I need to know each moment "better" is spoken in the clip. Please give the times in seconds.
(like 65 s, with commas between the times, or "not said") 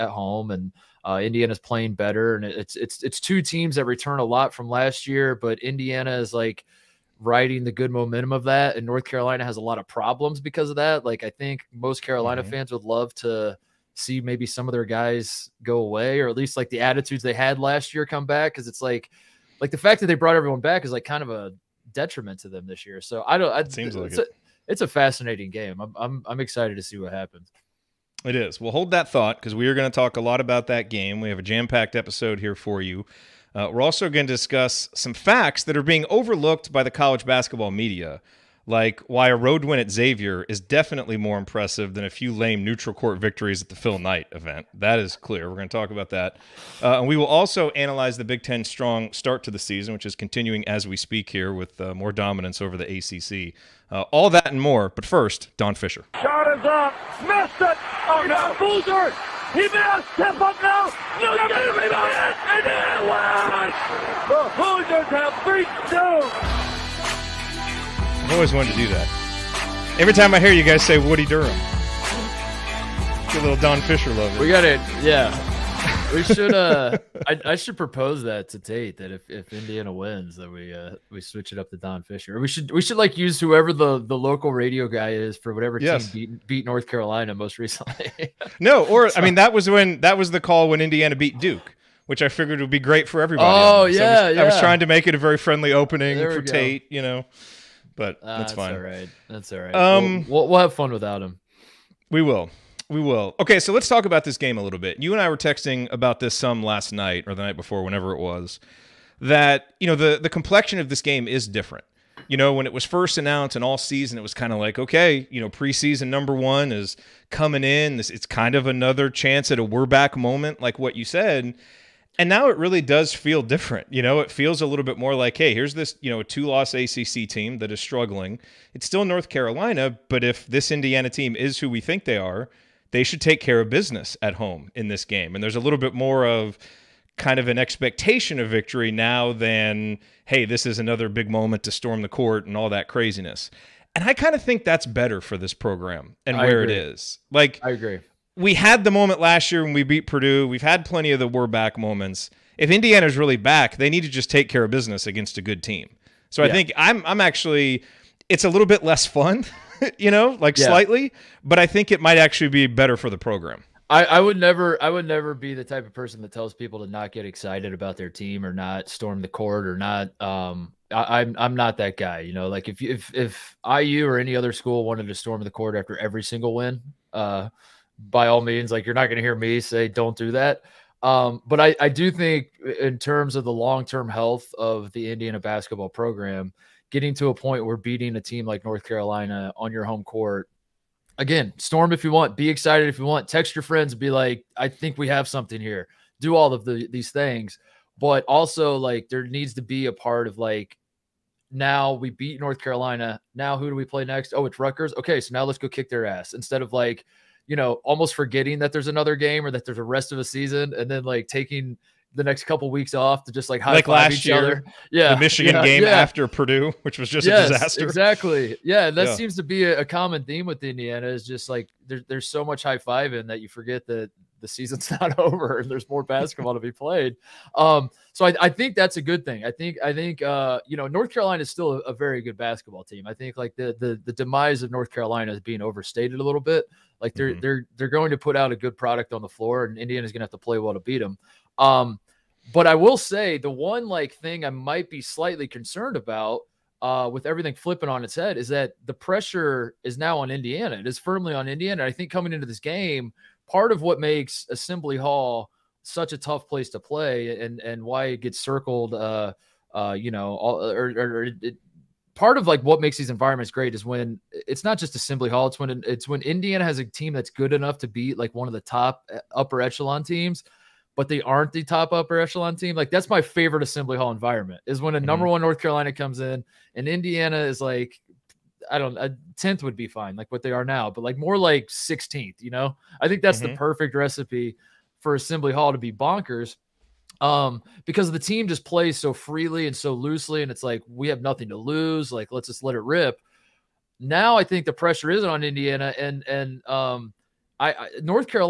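1 s, 144 s, 162 s.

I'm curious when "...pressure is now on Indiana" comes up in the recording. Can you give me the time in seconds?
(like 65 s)
248 s.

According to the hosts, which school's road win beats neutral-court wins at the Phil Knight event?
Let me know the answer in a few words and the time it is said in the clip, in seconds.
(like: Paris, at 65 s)
Xavier, at 39 s.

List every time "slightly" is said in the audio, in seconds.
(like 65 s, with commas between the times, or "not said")
160 s, 245 s.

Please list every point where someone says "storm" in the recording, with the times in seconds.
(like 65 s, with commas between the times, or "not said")
141 s, 168 s, 175 s, 191 s.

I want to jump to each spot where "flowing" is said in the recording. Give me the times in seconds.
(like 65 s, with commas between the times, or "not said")
not said.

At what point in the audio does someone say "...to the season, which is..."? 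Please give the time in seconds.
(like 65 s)
49 s.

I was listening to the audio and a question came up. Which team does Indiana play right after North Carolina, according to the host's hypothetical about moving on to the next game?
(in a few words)
Rutgers.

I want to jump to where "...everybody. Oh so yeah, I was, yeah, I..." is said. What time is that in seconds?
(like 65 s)
93 s.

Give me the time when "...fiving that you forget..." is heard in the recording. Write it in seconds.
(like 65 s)
222 s.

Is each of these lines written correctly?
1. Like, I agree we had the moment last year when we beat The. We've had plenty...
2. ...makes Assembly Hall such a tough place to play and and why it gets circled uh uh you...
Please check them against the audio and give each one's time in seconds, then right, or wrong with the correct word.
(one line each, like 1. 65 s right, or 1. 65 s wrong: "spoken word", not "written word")
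1. 147 s wrong: "Purdue", not "The"
2. 253 s right.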